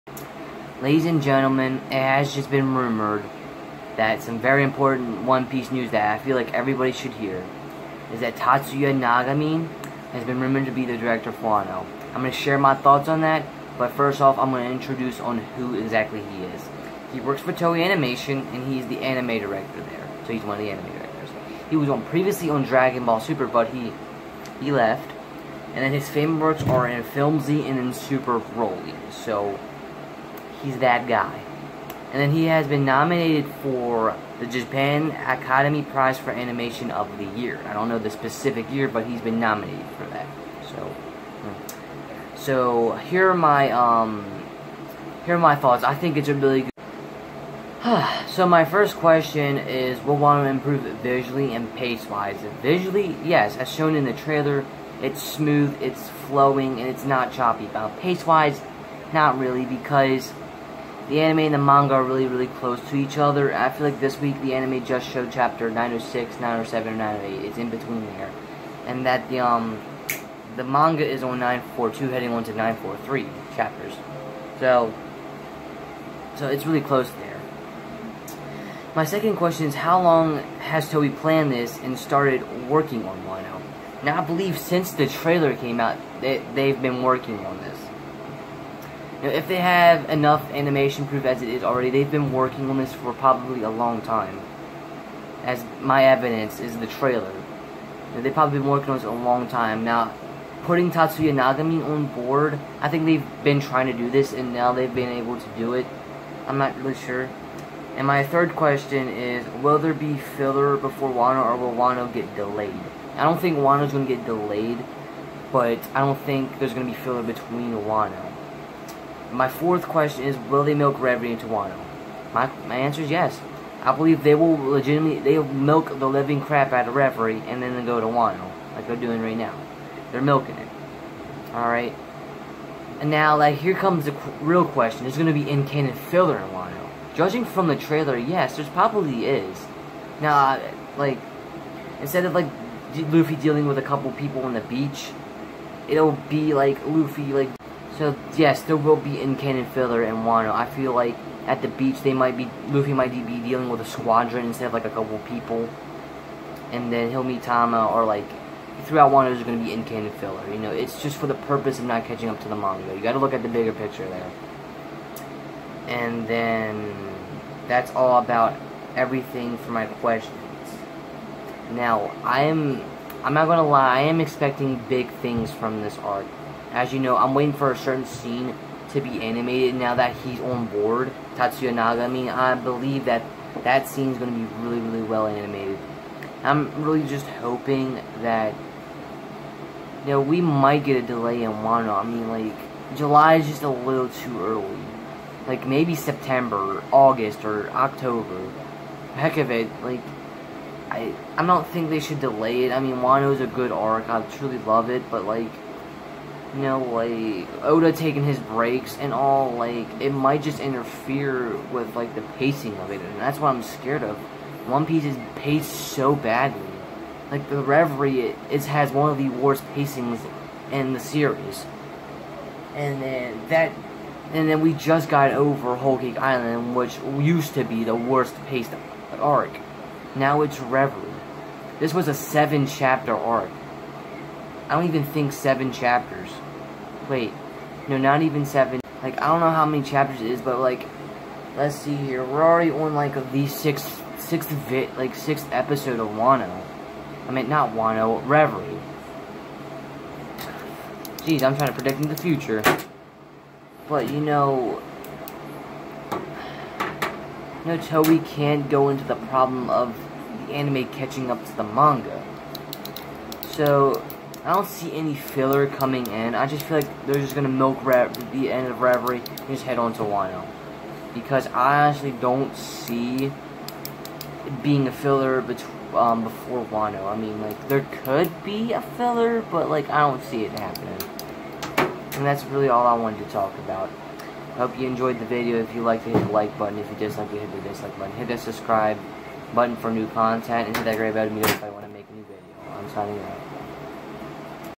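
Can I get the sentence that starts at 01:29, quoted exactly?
Now, if they have enough animation proof as it is already, they've been working on this for probably a long time.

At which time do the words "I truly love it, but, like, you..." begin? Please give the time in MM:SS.
03:24.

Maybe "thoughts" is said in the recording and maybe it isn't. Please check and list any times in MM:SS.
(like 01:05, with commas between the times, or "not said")
00:12, 00:45.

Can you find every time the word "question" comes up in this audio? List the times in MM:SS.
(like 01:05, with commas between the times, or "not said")
00:48, 01:19, 01:48, 01:59, 02:14, 02:49.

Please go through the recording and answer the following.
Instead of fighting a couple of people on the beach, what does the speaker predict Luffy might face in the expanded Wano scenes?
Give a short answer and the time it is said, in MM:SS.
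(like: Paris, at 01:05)
a squadron, at 02:33.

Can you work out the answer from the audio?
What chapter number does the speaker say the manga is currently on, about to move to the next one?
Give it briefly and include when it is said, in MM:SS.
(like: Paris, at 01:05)
942, at 01:11.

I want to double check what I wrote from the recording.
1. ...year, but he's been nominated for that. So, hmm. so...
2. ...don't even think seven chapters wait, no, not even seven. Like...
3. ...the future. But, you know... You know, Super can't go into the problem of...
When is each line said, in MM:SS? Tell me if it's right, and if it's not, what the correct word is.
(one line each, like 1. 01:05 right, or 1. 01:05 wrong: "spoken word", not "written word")
1. 00:38 right
2. 03:54 right
3. 04:12 wrong: "Toei", not "Super".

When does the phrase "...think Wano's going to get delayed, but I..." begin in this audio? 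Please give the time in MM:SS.
01:53.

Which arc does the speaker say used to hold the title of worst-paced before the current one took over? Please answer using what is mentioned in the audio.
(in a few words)
Whole Cake Island.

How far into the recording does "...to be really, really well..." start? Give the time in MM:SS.
03:04.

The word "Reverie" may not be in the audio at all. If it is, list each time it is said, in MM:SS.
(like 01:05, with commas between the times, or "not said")
02:00, 02:06, 03:37, 03:50, 04:08, 04:28.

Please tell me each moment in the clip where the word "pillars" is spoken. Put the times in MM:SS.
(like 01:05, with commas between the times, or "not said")
not said.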